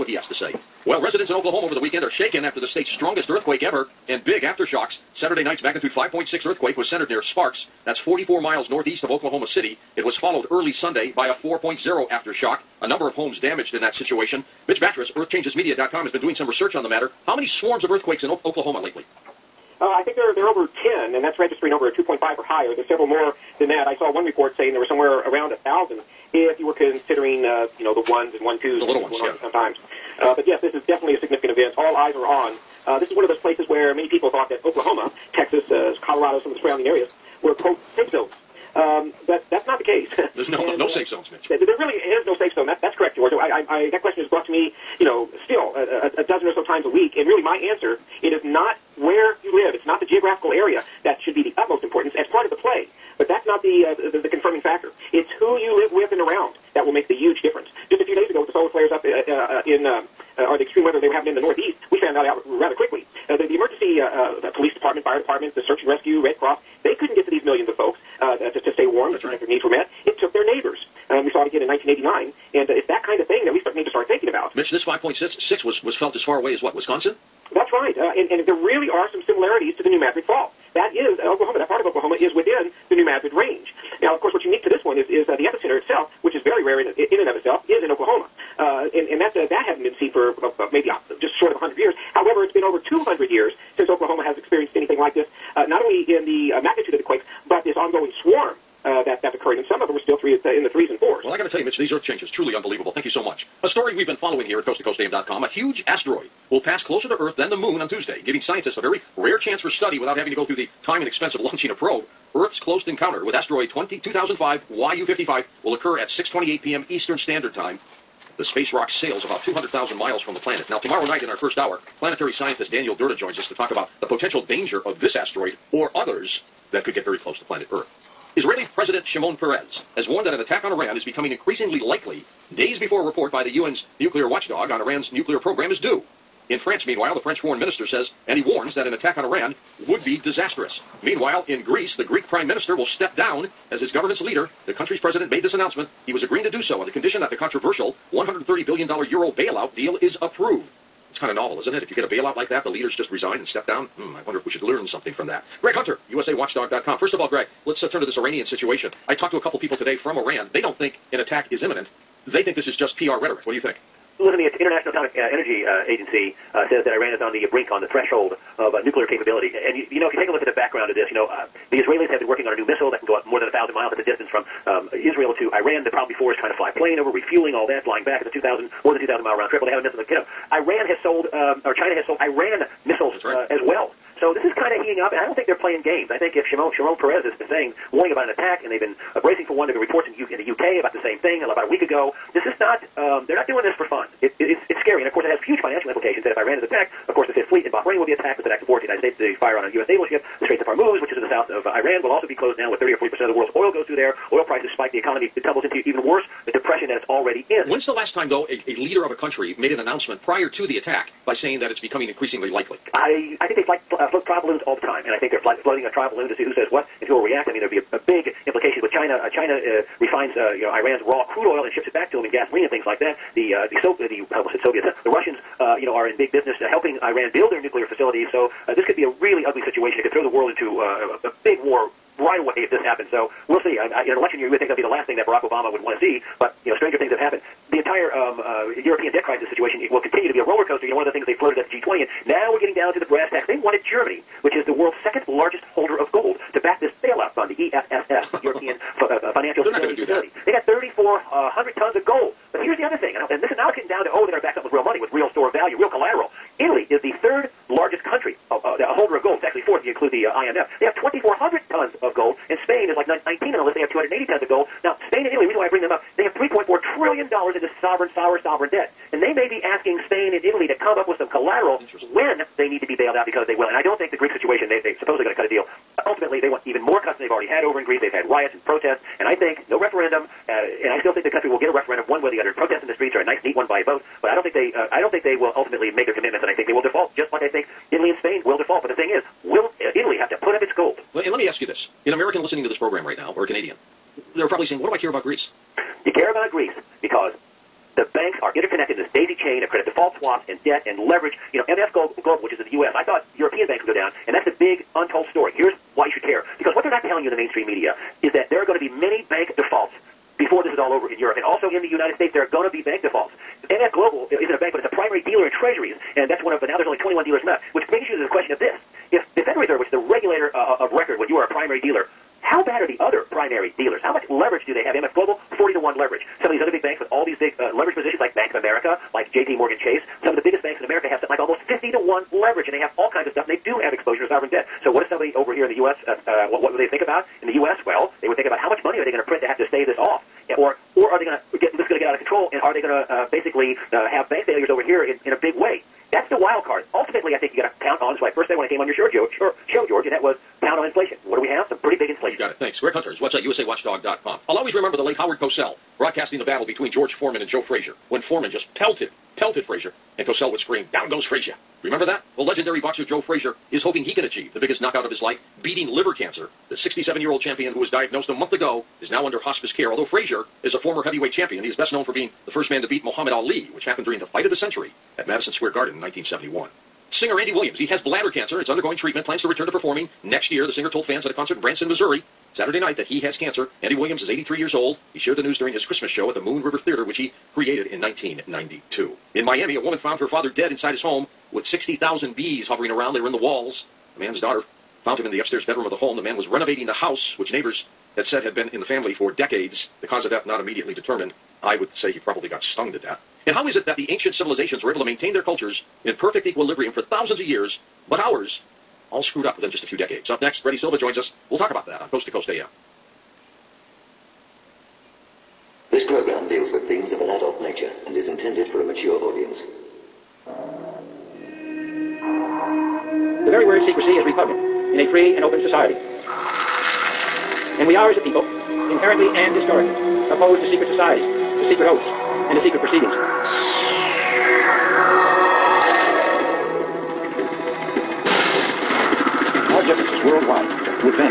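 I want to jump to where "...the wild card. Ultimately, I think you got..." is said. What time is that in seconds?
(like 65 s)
346 s.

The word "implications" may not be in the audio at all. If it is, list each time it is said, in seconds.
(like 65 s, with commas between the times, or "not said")
195 s, 218 s.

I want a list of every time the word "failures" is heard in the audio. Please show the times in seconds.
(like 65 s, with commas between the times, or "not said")
344 s.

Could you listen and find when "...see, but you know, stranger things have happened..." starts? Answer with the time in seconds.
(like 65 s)
236 s.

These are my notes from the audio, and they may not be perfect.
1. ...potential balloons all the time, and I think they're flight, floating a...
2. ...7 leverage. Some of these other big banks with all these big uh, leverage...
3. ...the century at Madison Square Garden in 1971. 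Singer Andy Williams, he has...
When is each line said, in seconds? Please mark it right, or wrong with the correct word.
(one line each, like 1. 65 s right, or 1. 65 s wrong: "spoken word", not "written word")
1. 214 s wrong: "trial", not "potential"
2. 325 s wrong: "1", not "7"
3. 374 s right.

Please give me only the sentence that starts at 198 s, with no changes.
It's an act of war to the United States.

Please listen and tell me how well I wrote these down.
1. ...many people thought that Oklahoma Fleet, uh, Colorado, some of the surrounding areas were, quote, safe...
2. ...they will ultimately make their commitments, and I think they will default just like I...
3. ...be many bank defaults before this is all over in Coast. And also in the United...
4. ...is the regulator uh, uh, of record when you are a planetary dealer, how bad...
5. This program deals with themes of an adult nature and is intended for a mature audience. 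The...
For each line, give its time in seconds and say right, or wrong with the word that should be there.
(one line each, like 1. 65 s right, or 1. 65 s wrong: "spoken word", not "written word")
1. 33 s wrong: "Texas", not "Fleet"
2. 285 s right
3. 308 s wrong: "Europe", not "Coast"
4. 319 s wrong: "primary", not "planetary"
5. 415 s right.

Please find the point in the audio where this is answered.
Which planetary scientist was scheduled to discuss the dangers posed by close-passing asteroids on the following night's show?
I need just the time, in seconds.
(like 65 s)
122 s.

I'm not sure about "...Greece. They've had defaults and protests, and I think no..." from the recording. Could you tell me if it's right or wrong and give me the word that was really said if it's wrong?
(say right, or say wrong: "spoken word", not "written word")
wrong: "riots", not "defaults".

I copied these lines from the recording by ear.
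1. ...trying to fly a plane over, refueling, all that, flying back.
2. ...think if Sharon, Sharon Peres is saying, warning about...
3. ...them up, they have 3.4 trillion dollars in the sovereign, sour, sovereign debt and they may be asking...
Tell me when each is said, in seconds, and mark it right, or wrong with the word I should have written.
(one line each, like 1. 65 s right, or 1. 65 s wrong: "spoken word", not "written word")
1. 176 s right
2. 186 s right
3. 265 s right.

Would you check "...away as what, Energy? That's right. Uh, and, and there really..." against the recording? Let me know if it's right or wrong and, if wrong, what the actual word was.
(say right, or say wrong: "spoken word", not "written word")
wrong: "Wisconsin", not "Energy".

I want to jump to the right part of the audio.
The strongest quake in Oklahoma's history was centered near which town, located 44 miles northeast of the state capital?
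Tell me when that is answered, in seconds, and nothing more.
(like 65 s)
7 s.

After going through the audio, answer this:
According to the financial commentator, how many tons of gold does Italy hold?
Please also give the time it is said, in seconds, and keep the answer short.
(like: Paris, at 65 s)
2,400, at 260 s.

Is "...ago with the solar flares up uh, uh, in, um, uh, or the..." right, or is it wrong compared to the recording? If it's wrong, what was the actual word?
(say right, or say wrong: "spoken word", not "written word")
right.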